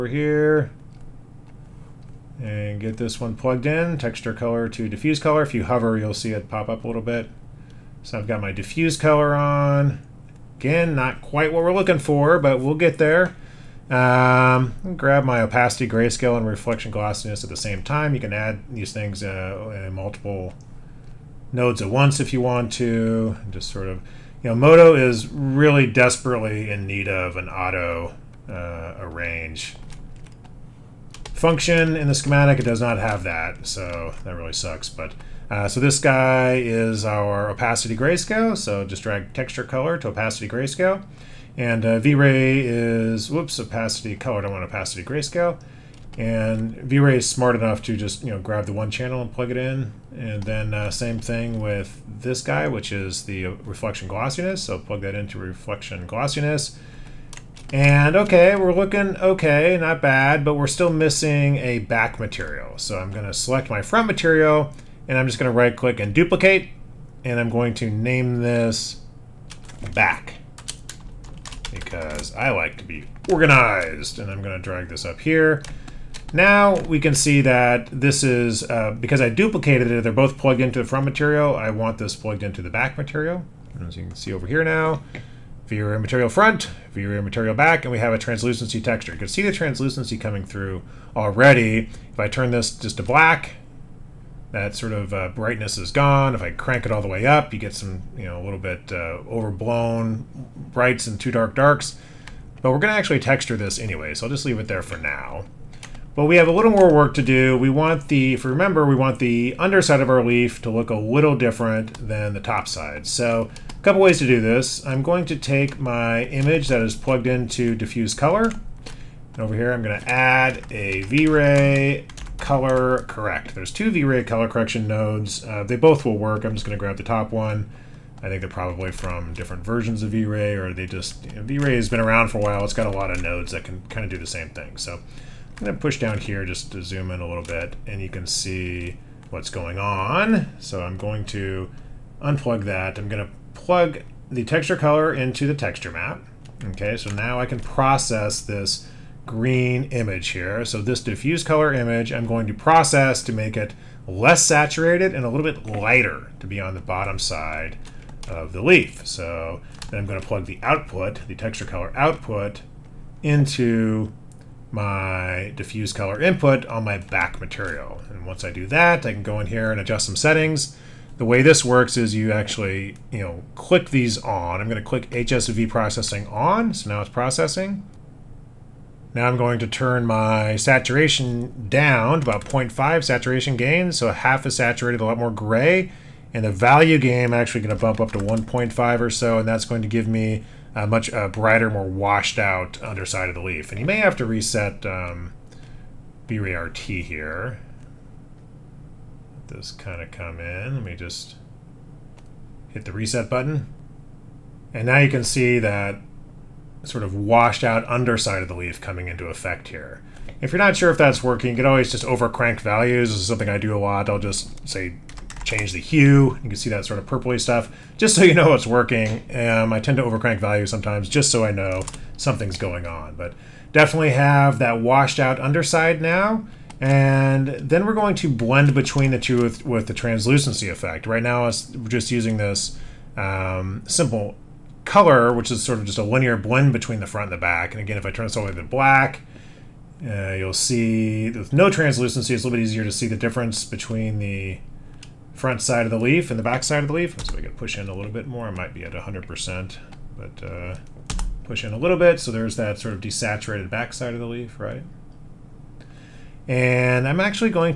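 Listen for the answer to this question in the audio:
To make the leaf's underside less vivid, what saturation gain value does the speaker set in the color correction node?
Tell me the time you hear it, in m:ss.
3:02.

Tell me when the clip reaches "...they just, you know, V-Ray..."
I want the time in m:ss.
2:10.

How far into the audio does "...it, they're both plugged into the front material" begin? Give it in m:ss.
1:19.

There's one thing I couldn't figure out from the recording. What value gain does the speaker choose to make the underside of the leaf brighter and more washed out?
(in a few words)
1.5.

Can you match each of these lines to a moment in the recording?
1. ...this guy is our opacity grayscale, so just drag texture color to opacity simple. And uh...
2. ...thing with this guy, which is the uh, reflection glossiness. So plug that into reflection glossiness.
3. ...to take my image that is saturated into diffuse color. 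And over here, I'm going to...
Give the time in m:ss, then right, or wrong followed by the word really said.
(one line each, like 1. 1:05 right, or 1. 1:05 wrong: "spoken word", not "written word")
1. 0:35 wrong: "grayscale", not "simple"
2. 0:51 right
3. 1:55 wrong: "plugged", not "saturated".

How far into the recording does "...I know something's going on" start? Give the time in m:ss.
3:41.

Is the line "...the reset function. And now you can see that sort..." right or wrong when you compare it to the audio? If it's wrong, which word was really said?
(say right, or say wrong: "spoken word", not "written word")
wrong: "button", not "function".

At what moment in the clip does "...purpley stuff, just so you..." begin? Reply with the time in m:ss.
3:37.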